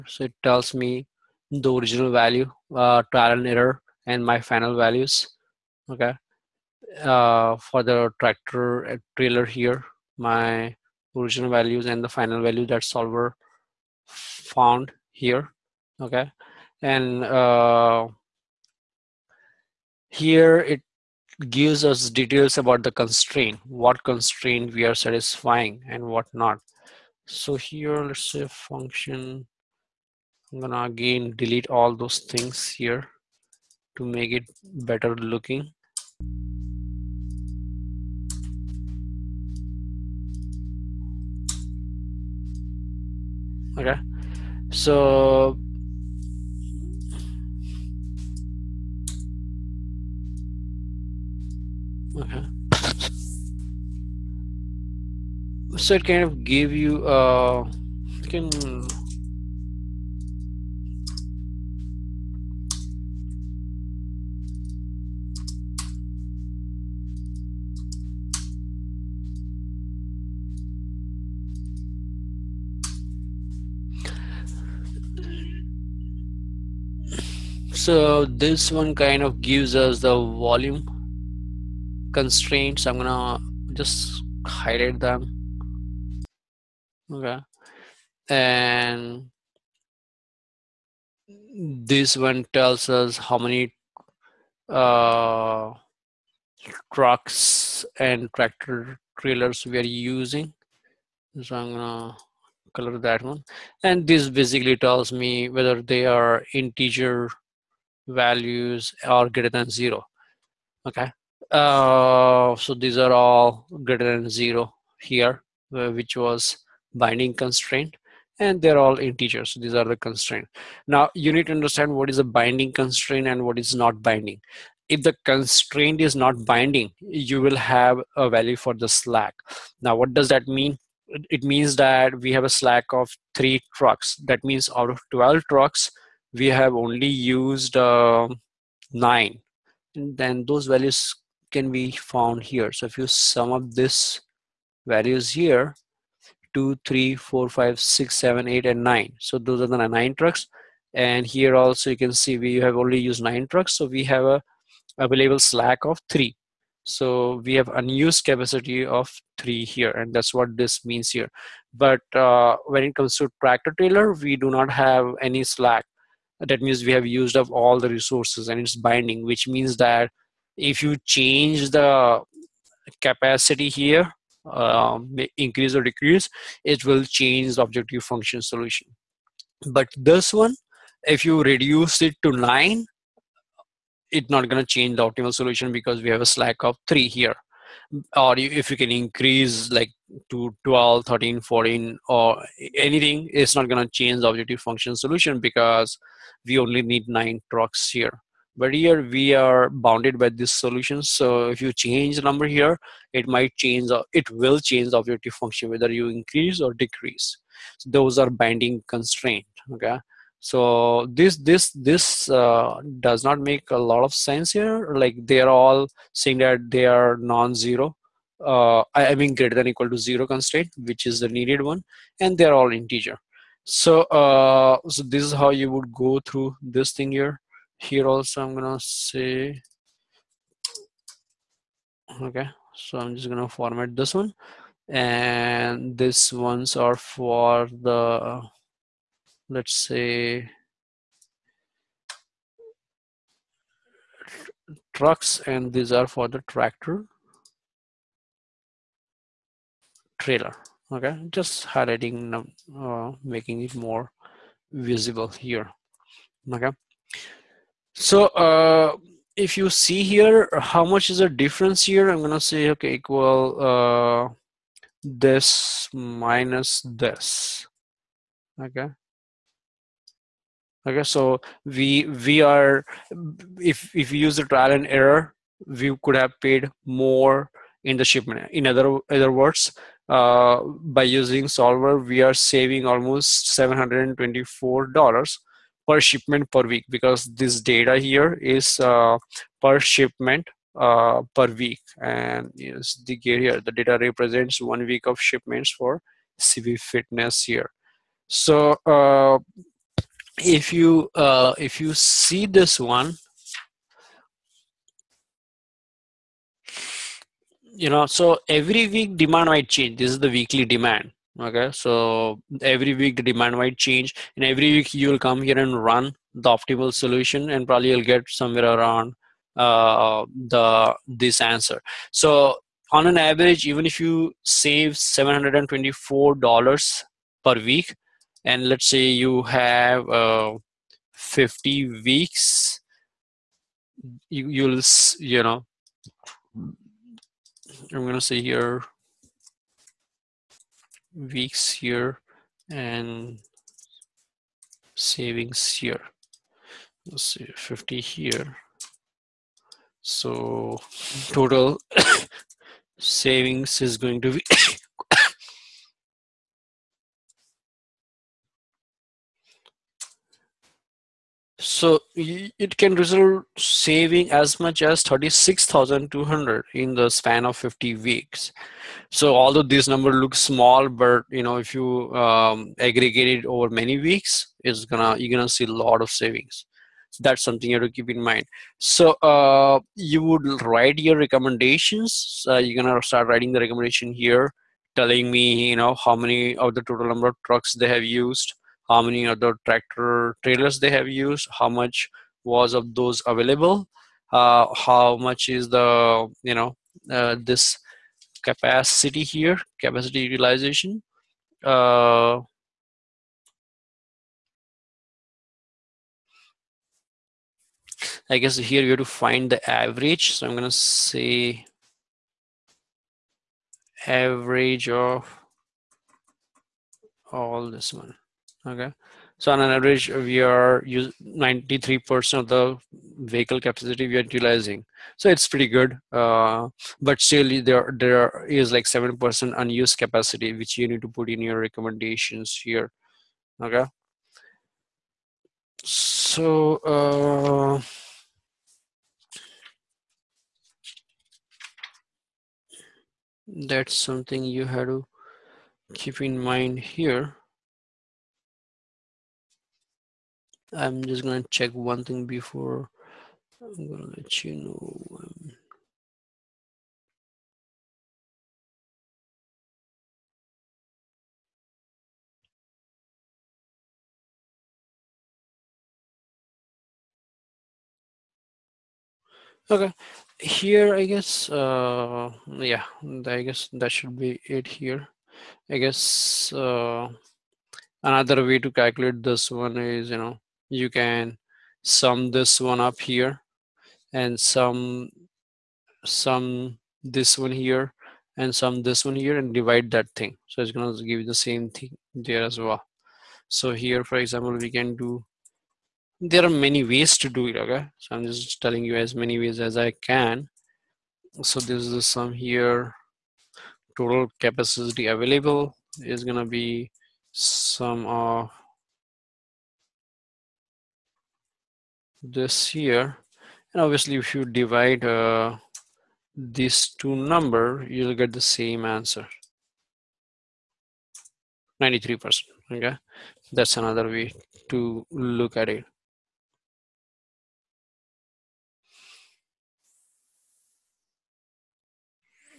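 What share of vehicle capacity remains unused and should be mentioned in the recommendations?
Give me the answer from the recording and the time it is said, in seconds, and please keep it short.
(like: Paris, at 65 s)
7%, at 428 s.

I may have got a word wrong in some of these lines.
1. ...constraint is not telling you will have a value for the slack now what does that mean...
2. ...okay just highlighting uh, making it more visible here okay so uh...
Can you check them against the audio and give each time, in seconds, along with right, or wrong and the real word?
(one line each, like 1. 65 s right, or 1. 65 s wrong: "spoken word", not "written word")
1. 125 s wrong: "binding", not "telling"
2. 250 s right.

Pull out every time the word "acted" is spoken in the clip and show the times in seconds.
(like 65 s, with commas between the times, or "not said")
not said.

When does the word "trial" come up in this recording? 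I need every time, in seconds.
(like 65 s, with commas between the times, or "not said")
3 s, 274 s.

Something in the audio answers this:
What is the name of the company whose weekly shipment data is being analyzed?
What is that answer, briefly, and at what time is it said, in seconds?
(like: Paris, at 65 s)
CV Fitness, at 296 s.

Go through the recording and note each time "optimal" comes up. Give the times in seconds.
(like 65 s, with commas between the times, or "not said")
185 s, 316 s.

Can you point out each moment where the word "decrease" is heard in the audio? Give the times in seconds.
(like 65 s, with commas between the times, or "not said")
175 s, 206 s.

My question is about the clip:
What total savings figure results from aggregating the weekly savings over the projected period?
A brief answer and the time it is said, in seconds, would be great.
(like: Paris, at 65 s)
36,200, at 365 s.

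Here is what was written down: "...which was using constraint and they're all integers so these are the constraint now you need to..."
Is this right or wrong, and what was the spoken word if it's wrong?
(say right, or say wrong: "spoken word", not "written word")
wrong: "binding", not "using".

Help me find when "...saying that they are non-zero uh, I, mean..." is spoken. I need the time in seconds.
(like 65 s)
216 s.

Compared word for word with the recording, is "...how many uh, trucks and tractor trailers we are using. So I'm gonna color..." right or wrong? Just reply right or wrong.
right.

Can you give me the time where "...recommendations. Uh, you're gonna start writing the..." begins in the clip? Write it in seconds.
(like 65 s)
381 s.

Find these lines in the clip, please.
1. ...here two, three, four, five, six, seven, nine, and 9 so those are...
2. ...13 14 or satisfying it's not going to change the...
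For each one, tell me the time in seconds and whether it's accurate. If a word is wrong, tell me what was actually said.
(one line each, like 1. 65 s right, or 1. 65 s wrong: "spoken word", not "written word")
1. 145 s wrong: "eight", not "nine"
2. 191 s wrong: "anything", not "satisfying".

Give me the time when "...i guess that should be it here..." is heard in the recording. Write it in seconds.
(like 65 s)
473 s.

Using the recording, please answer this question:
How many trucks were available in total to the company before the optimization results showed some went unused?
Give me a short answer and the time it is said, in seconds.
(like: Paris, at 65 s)
12, at 135 s.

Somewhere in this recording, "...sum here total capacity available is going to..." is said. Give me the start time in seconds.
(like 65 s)
502 s.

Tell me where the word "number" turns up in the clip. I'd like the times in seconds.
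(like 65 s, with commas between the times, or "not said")
202 s, 369 s, 387 s, 517 s.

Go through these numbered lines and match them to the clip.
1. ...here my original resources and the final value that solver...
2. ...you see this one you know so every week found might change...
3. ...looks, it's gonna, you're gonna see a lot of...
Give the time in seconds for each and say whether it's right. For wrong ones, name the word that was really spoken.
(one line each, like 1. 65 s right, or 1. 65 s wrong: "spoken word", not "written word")
1. 9 s wrong: "values", not "resources"
2. 301 s wrong: "demand", not "found"
3. 373 s wrong: "weeks", not "looks".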